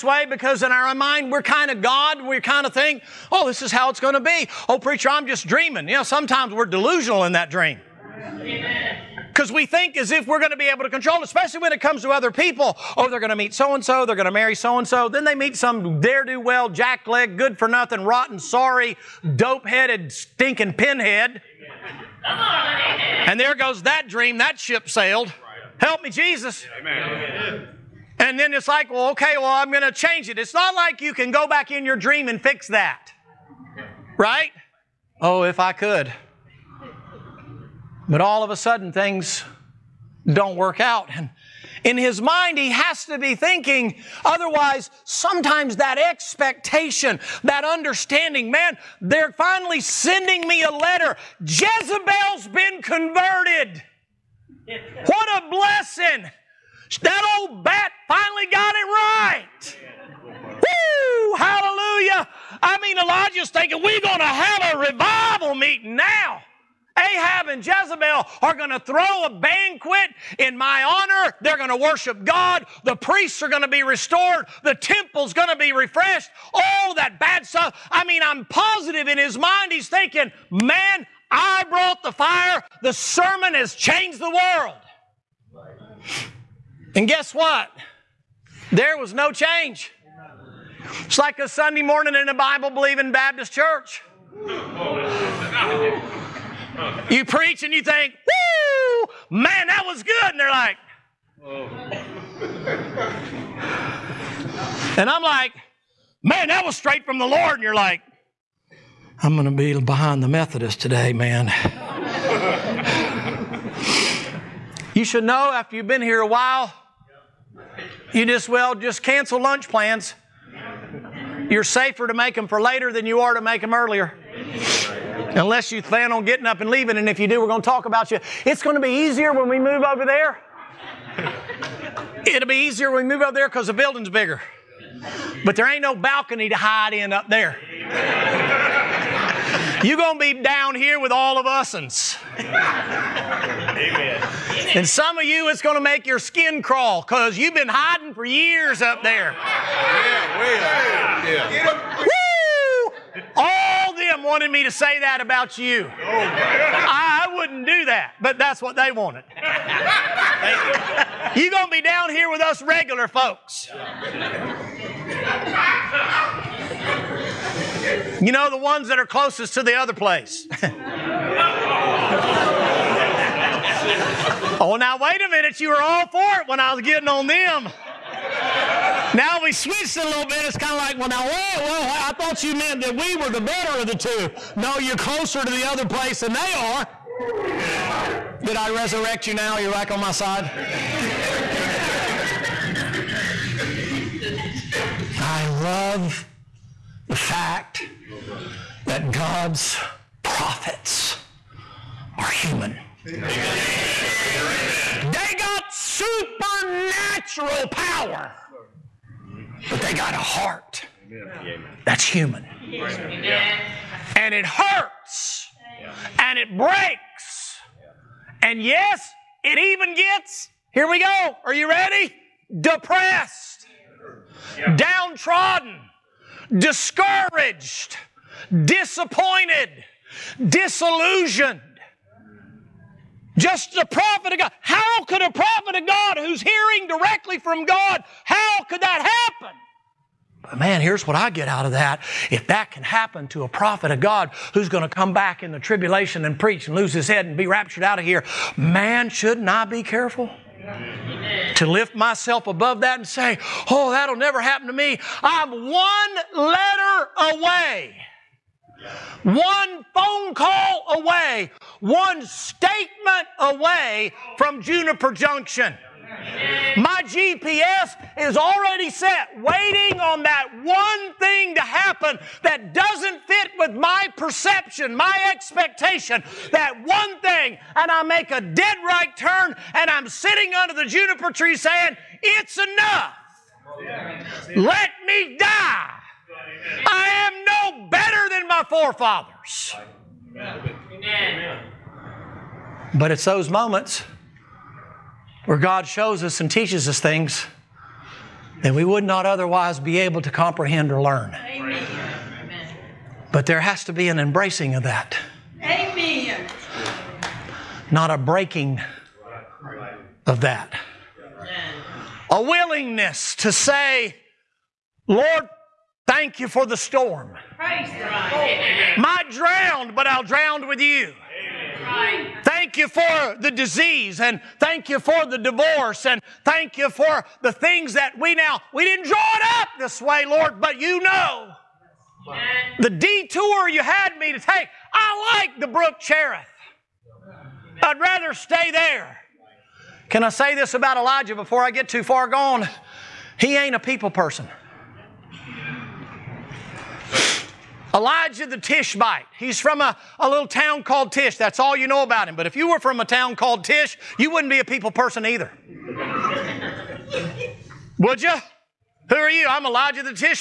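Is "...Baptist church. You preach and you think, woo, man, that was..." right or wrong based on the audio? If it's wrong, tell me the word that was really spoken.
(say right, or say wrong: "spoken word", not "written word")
right.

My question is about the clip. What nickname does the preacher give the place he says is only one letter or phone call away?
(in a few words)
Juniper Junction.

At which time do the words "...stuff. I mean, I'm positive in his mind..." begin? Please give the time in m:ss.
1:17.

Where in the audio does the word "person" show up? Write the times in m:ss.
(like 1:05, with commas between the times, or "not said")
5:44, 5:54.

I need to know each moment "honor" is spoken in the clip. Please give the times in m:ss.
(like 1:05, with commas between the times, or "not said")
1:10.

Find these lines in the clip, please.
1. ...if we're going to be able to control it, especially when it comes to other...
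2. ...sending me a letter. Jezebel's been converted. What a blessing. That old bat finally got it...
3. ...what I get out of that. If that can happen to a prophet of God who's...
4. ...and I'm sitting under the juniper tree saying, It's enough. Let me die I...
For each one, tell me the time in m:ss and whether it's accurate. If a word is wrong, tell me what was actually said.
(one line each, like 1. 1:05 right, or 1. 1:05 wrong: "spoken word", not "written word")
1. 0:10 right
2. 0:49 right
3. 4:01 right
4. 4:39 right.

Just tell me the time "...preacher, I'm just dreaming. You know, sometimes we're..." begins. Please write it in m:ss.
0:04.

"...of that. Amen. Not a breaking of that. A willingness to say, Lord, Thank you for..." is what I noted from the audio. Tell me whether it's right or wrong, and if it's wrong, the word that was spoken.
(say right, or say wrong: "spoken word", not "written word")
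right.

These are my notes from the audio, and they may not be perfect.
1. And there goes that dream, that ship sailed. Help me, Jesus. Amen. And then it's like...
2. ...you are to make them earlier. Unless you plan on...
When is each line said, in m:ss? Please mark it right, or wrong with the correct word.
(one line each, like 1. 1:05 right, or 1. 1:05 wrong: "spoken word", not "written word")
1. 0:22 right
2. 2:03 right.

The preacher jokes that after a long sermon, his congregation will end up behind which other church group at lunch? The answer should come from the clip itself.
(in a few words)
the Methodist.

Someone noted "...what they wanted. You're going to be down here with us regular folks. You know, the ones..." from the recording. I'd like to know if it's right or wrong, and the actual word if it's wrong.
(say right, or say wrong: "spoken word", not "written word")
right.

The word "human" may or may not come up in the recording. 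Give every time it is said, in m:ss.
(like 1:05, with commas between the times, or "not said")
3:22, 3:32.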